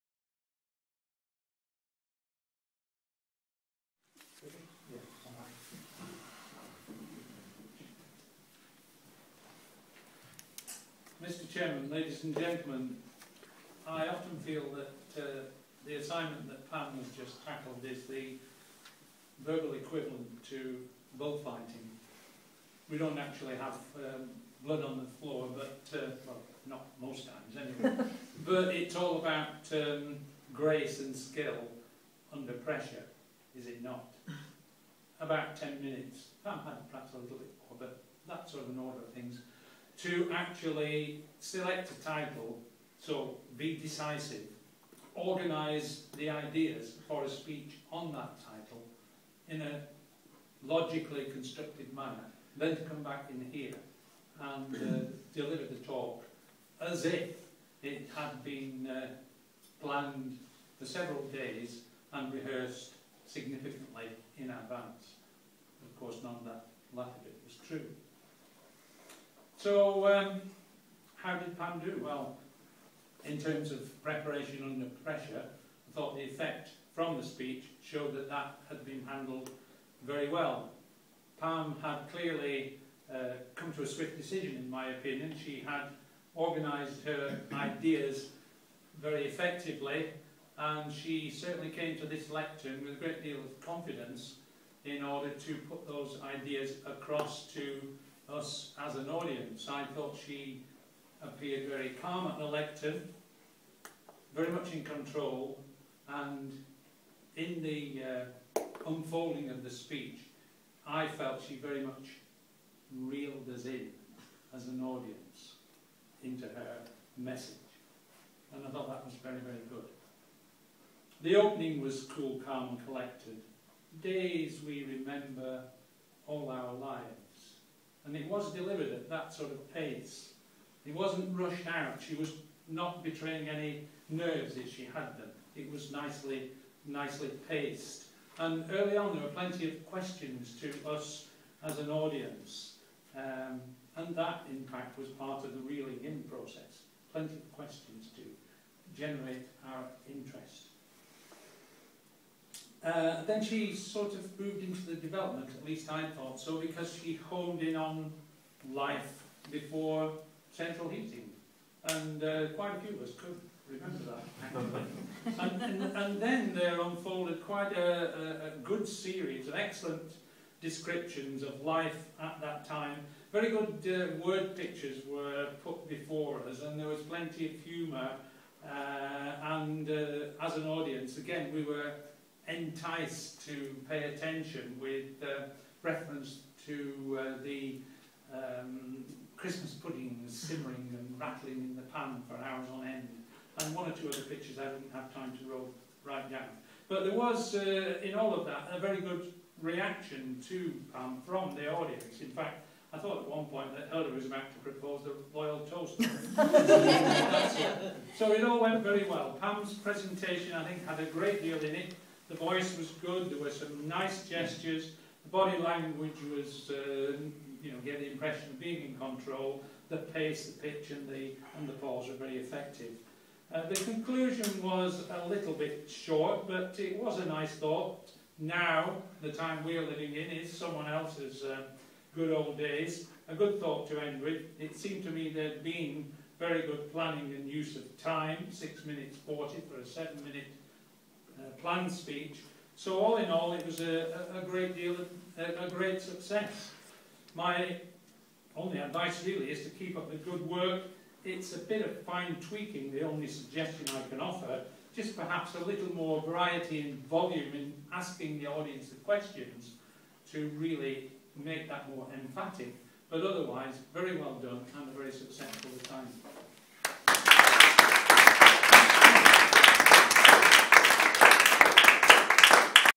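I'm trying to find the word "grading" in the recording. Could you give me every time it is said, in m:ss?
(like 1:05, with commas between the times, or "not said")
not said.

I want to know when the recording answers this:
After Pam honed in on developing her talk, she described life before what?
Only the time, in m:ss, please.
2:40.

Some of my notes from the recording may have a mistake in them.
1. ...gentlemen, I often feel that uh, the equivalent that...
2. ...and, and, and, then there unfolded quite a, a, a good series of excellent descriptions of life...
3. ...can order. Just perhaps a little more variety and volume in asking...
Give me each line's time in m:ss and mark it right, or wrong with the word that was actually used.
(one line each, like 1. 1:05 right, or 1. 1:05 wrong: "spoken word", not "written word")
1. 0:12 wrong: "assignment", not "equivalent"
2. 2:45 right
3. 4:14 wrong: "offer", not "order".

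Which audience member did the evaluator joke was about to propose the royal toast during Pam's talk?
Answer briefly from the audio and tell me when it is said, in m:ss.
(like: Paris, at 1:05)
Hilda, at 3:23.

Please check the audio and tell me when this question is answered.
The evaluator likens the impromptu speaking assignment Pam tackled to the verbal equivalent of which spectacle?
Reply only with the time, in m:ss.
0:21.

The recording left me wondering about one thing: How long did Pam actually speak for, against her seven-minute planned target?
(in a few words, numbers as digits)
6 minutes 40.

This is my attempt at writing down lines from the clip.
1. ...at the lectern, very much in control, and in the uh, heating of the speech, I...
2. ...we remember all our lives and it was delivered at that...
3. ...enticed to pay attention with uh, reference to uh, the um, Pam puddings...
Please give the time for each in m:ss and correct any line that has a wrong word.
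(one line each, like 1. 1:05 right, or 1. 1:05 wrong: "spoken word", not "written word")
1. 1:42 wrong: "unfolding", not "heating"
2. 2:04 right
3. 3:02 wrong: "Christmas", not "Pam".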